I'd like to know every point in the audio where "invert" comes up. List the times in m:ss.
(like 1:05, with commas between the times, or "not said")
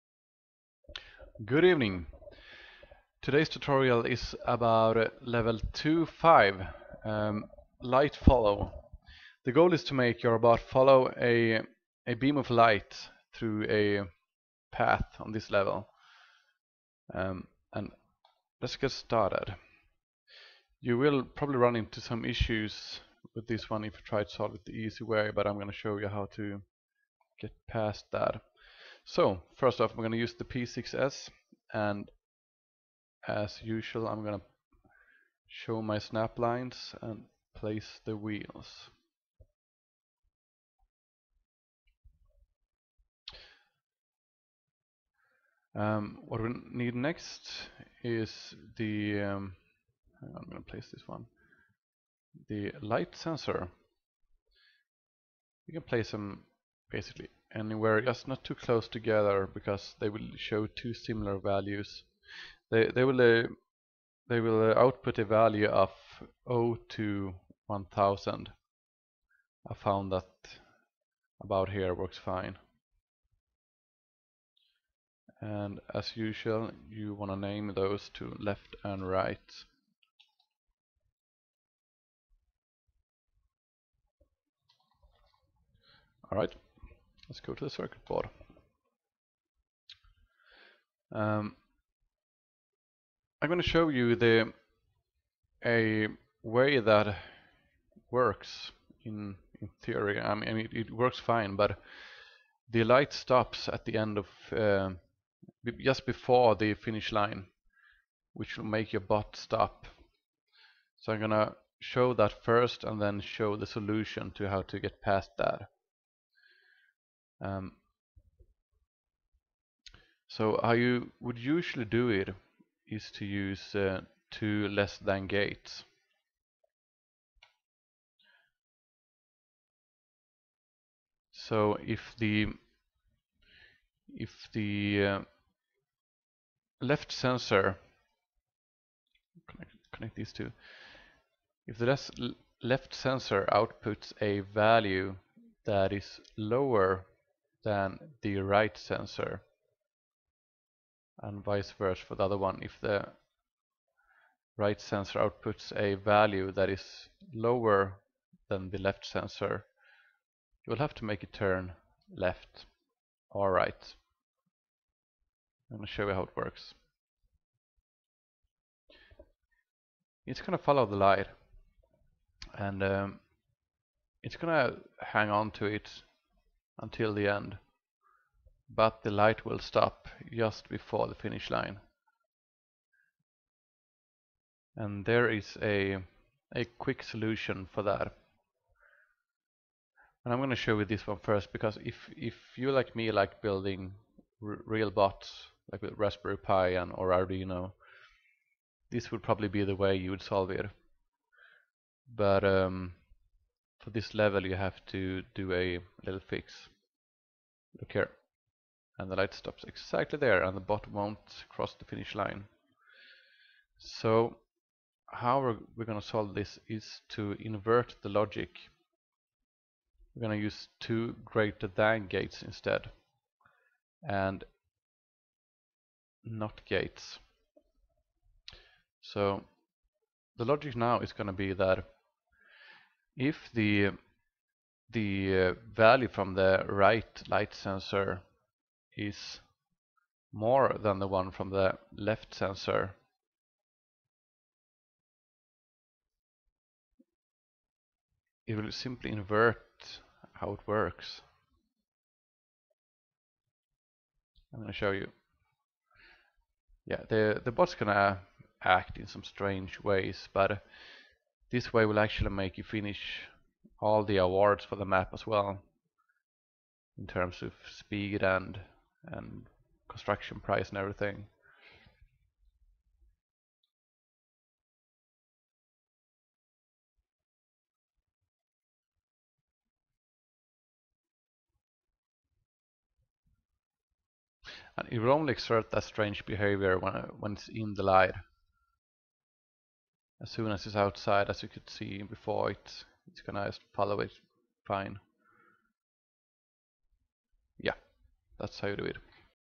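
3:37, 4:09.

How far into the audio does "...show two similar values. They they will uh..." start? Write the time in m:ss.
1:00.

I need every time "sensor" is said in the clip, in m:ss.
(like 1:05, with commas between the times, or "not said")
0:53, 2:17, 2:22, 2:28, 2:34, 2:39, 3:57, 4:02.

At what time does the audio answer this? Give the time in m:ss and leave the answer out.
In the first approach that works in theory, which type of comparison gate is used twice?
2:04.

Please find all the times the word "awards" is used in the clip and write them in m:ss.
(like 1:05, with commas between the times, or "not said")
4:24.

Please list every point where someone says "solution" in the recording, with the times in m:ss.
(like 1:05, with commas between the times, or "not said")
1:53, 3:07.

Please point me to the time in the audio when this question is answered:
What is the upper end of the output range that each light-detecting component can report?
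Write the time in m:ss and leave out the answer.
1:07.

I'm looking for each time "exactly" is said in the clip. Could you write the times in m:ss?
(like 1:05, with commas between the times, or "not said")
3:29.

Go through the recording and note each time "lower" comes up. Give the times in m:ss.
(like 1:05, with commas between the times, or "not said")
2:26, 2:37.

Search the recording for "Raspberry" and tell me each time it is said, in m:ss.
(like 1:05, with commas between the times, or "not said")
3:15.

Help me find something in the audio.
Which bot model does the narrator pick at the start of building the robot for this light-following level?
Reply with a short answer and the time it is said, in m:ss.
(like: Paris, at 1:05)
P6S, at 0:30.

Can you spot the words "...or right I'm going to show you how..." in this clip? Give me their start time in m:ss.
2:43.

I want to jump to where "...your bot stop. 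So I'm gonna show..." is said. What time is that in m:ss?
1:48.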